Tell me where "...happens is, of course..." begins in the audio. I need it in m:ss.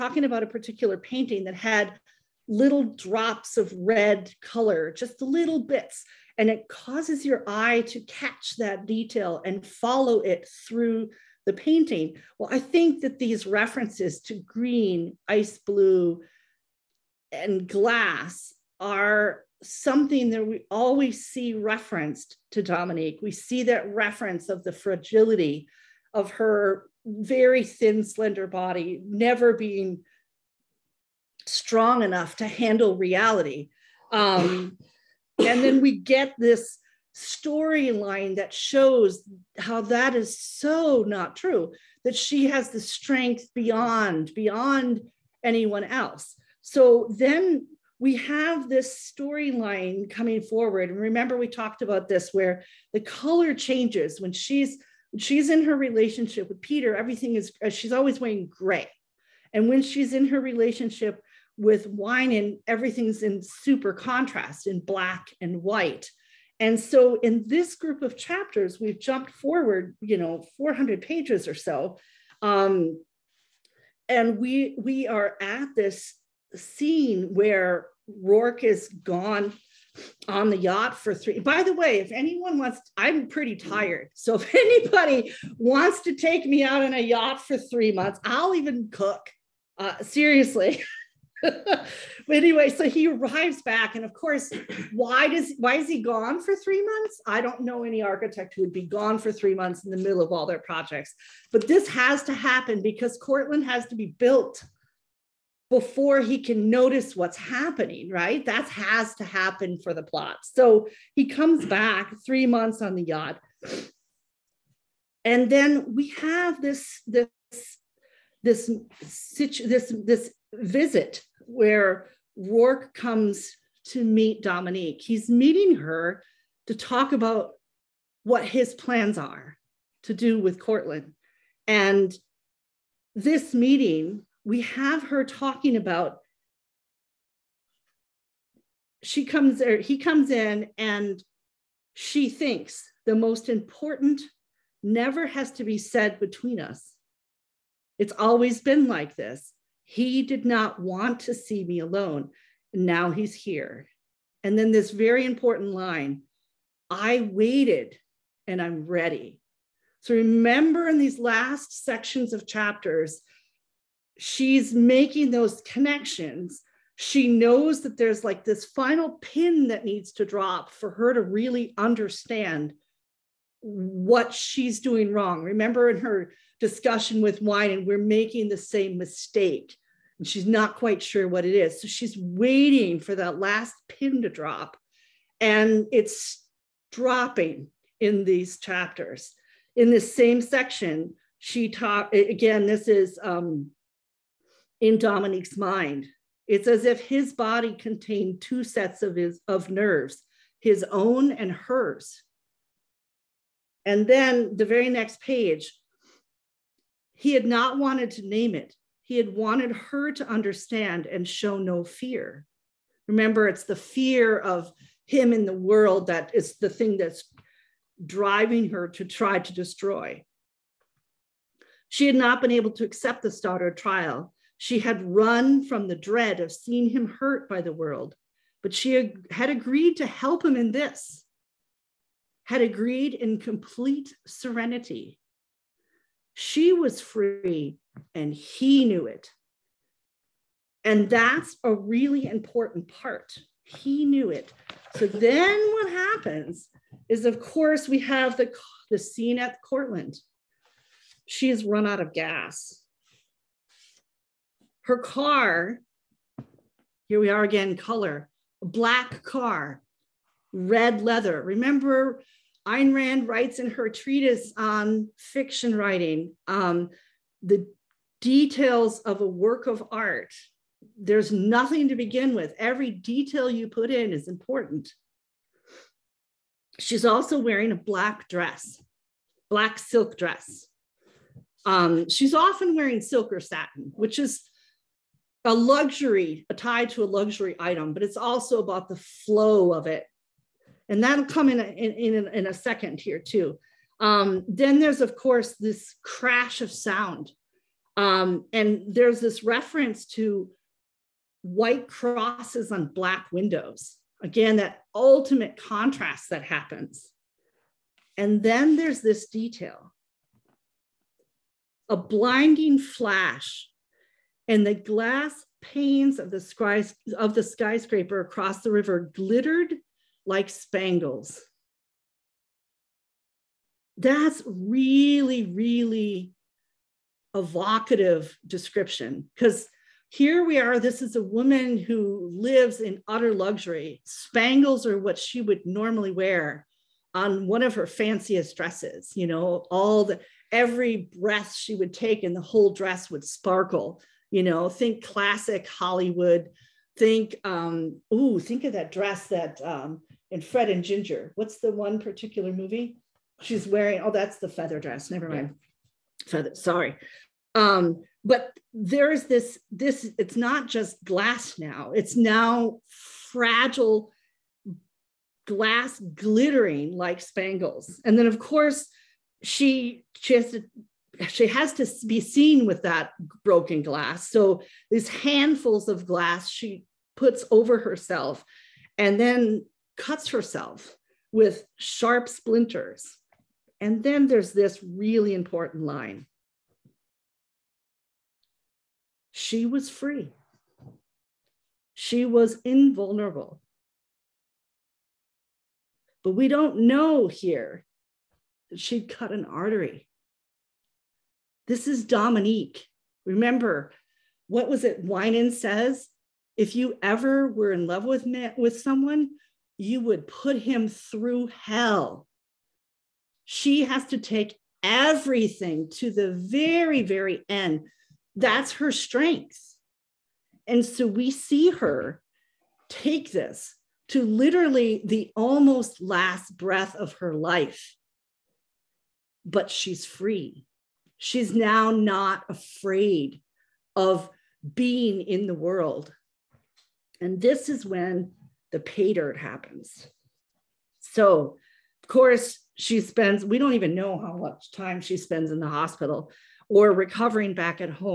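4:05.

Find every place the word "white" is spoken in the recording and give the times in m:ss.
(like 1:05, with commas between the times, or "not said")
1:05, 5:01.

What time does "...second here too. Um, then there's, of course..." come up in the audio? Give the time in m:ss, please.
4:52.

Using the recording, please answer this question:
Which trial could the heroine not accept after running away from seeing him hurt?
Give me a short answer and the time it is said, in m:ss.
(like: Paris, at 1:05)
Stoddard, at 3:43.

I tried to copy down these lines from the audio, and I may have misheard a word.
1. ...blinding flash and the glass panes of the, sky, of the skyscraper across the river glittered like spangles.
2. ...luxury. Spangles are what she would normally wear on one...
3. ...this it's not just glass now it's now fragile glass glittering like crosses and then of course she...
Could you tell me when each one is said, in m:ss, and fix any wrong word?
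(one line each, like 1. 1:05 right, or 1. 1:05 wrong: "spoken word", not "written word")
1. 5:11 right
2. 5:33 right
3. 5:59 wrong: "spangles", not "crosses".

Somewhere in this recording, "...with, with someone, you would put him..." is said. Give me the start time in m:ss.
6:48.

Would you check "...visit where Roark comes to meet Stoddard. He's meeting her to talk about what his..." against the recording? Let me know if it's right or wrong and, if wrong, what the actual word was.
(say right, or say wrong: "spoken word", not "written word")
wrong: "Dominique", not "Stoddard".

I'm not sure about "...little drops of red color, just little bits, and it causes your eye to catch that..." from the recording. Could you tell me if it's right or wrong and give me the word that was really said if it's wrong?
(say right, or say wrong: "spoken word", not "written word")
right.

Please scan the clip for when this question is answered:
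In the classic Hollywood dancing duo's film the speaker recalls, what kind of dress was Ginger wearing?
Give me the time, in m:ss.
5:54.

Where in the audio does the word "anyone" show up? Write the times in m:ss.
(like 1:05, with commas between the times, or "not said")
0:45, 1:22.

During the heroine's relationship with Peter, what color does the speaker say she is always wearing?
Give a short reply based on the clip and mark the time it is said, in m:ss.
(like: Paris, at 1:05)
Gray, at 0:58.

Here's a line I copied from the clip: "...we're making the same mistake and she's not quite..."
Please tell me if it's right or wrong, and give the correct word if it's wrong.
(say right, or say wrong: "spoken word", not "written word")
right.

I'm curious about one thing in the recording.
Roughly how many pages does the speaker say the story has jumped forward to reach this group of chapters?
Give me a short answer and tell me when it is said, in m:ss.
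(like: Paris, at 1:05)
400, at 1:10.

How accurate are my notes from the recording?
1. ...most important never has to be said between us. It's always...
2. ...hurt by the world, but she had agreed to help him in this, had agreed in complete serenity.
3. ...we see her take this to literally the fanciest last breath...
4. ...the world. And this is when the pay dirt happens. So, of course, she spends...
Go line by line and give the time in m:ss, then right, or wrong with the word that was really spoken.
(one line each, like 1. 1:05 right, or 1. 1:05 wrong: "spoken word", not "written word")
1. 2:23 right
2. 3:47 right
3. 7:01 wrong: "almost", not "fanciest"
4. 7:15 right.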